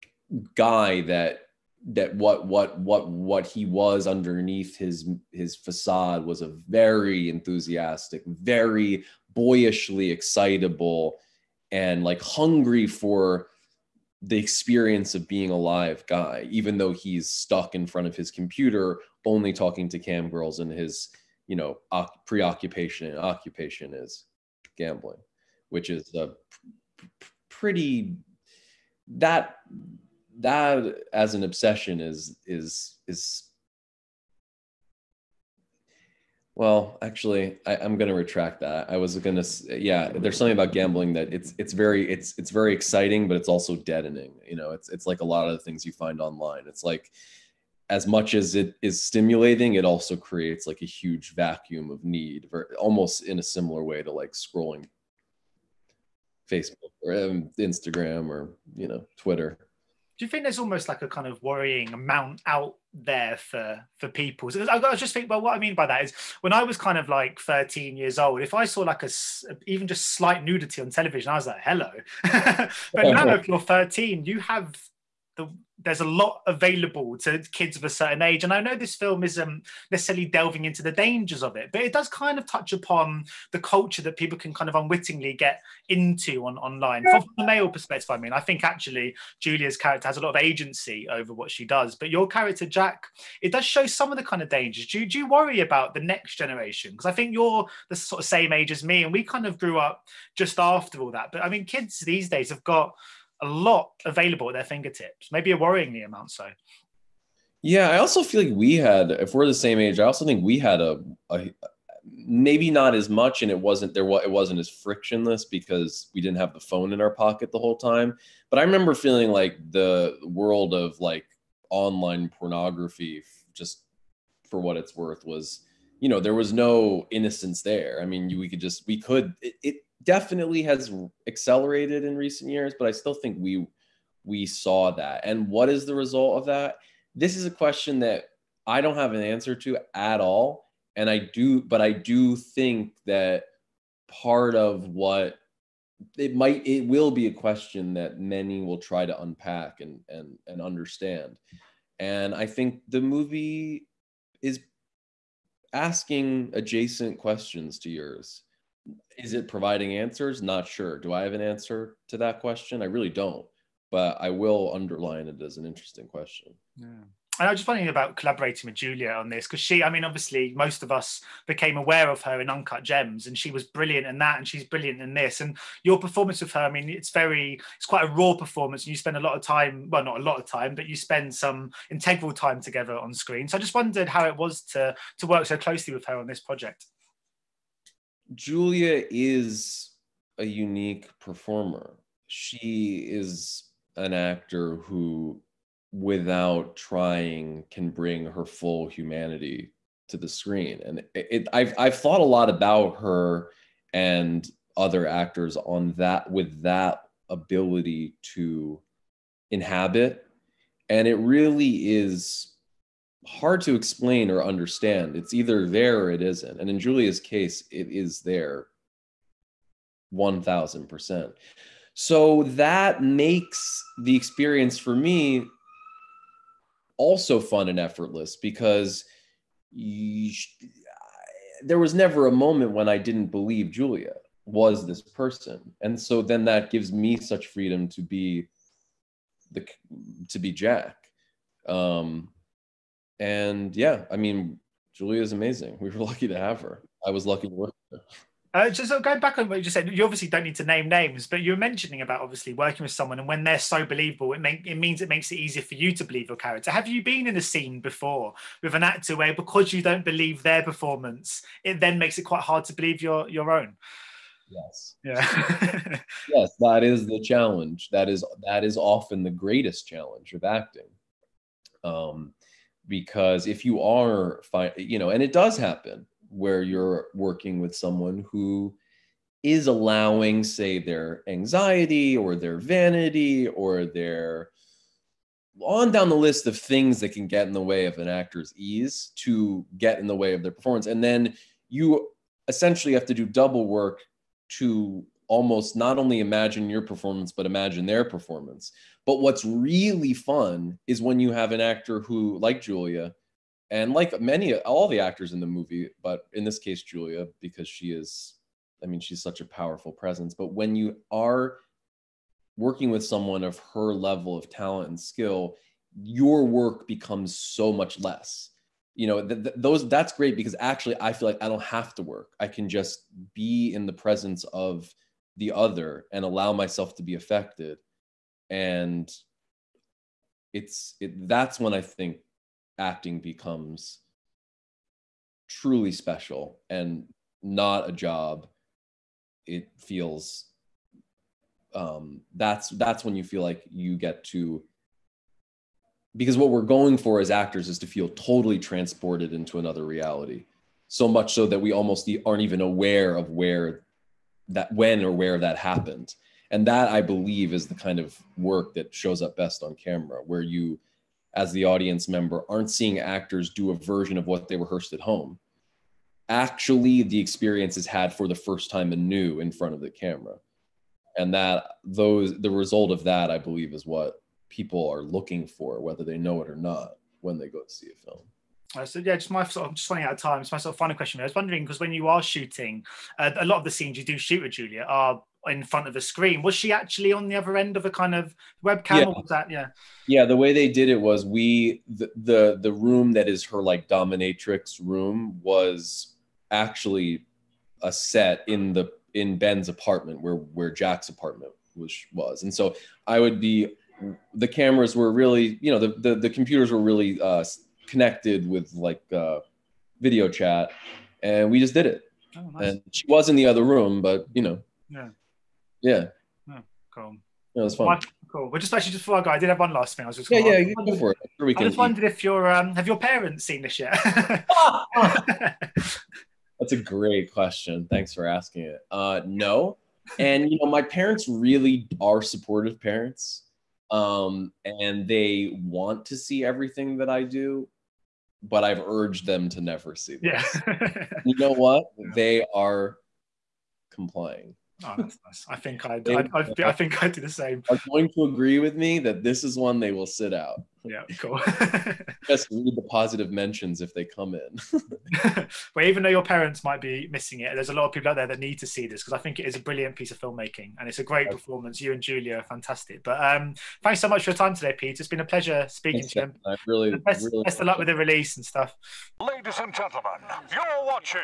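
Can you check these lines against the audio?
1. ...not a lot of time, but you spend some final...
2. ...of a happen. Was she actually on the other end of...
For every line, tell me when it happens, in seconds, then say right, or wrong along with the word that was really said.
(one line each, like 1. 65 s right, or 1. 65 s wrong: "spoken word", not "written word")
1. 180 s wrong: "integral", not "final"
2. 385 s wrong: "screen", not "happen".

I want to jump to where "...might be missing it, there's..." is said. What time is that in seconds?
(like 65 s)
456 s.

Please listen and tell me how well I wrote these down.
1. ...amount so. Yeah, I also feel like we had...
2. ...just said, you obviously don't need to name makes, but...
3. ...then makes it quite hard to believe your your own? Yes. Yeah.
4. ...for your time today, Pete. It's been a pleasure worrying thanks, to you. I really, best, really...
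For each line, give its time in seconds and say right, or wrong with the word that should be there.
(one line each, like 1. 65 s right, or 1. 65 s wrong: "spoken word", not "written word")
1. 106 s right
2. 249 s wrong: "names", not "makes"
3. 261 s right
4. 464 s wrong: "speaking", not "worrying".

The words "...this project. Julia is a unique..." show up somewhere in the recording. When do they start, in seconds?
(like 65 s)
186 s.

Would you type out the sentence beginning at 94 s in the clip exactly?
Do, do you worry about the next generation?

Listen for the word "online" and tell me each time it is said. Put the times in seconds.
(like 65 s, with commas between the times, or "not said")
46 s, 86 s, 121 s.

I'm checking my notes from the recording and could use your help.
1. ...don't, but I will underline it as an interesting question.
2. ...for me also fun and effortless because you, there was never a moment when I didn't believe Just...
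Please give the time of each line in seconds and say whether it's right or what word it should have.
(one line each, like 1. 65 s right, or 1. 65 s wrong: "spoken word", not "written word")
1. 163 s right
2. 224 s wrong: "Julia", not "Just".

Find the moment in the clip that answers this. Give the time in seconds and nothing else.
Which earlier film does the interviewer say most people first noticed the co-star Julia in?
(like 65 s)
172 s.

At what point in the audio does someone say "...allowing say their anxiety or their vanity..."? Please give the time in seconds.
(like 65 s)
279 s.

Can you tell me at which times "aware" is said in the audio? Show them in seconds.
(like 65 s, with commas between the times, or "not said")
171 s, 352 s.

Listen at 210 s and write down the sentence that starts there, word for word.
And it really is hard to explain or understand.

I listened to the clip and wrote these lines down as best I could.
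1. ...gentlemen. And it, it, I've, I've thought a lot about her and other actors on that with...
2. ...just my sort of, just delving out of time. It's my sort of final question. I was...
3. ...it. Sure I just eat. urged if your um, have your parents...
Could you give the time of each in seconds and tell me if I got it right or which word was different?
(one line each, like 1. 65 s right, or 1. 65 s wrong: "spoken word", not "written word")
1. 200 s wrong: "screen", not "gentlemen"
2. 379 s wrong: "running", not "delving"
3. 421 s wrong: "wondered", not "urged".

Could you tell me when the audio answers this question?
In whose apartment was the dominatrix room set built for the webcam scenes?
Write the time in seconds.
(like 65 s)
399 s.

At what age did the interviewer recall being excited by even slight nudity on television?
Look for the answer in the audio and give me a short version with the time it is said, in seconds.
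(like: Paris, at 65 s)
13, at 67 s.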